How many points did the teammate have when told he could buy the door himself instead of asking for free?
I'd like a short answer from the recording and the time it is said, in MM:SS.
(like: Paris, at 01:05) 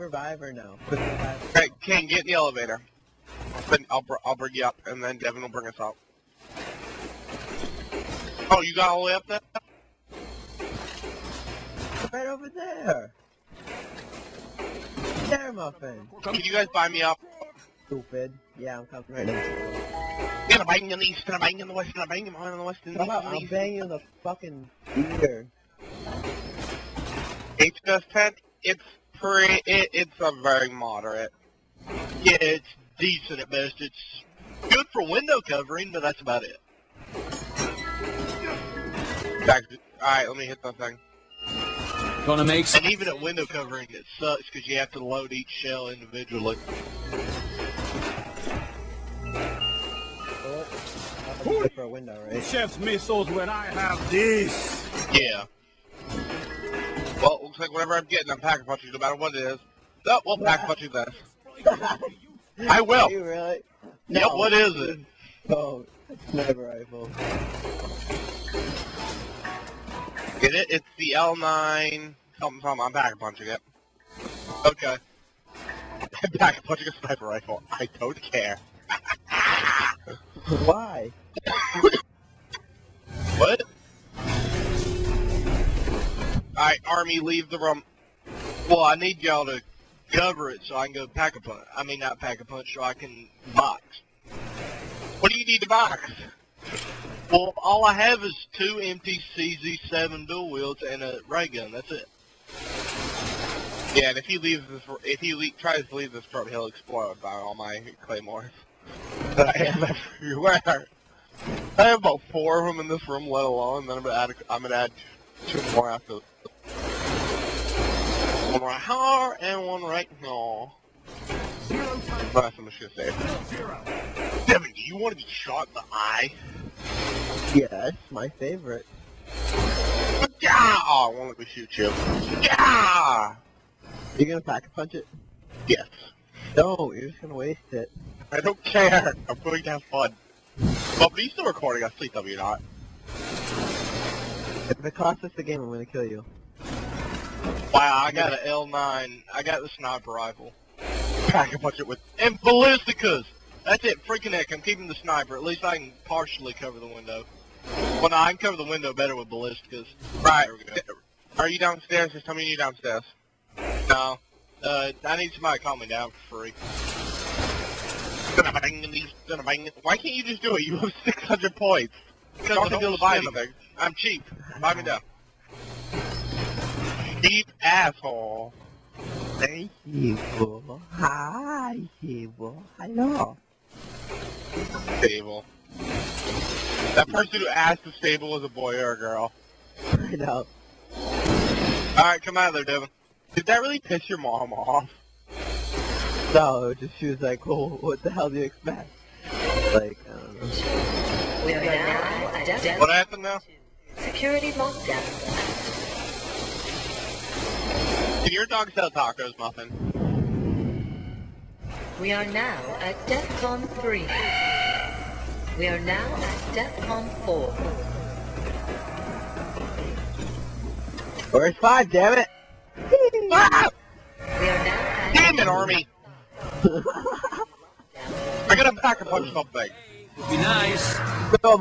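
600, at 02:51.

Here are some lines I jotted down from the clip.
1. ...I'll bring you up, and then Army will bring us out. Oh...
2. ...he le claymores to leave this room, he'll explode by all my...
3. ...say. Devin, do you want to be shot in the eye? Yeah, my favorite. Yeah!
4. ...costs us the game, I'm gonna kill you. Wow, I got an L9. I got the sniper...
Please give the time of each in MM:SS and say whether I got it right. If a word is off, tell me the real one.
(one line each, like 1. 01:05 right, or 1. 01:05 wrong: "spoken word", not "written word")
1. 00:04 wrong: "Devin", not "Army"
2. 01:45 wrong: "tries", not "claymores"
3. 02:03 right
4. 02:24 right.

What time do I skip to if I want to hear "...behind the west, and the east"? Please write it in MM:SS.
00:22.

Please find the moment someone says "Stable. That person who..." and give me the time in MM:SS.
03:04.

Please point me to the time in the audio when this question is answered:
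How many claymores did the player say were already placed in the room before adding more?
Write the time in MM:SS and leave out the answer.
01:51.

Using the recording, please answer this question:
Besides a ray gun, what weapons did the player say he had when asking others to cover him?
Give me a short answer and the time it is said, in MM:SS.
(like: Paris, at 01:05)
MPCZ 7 dual wield, at 01:38.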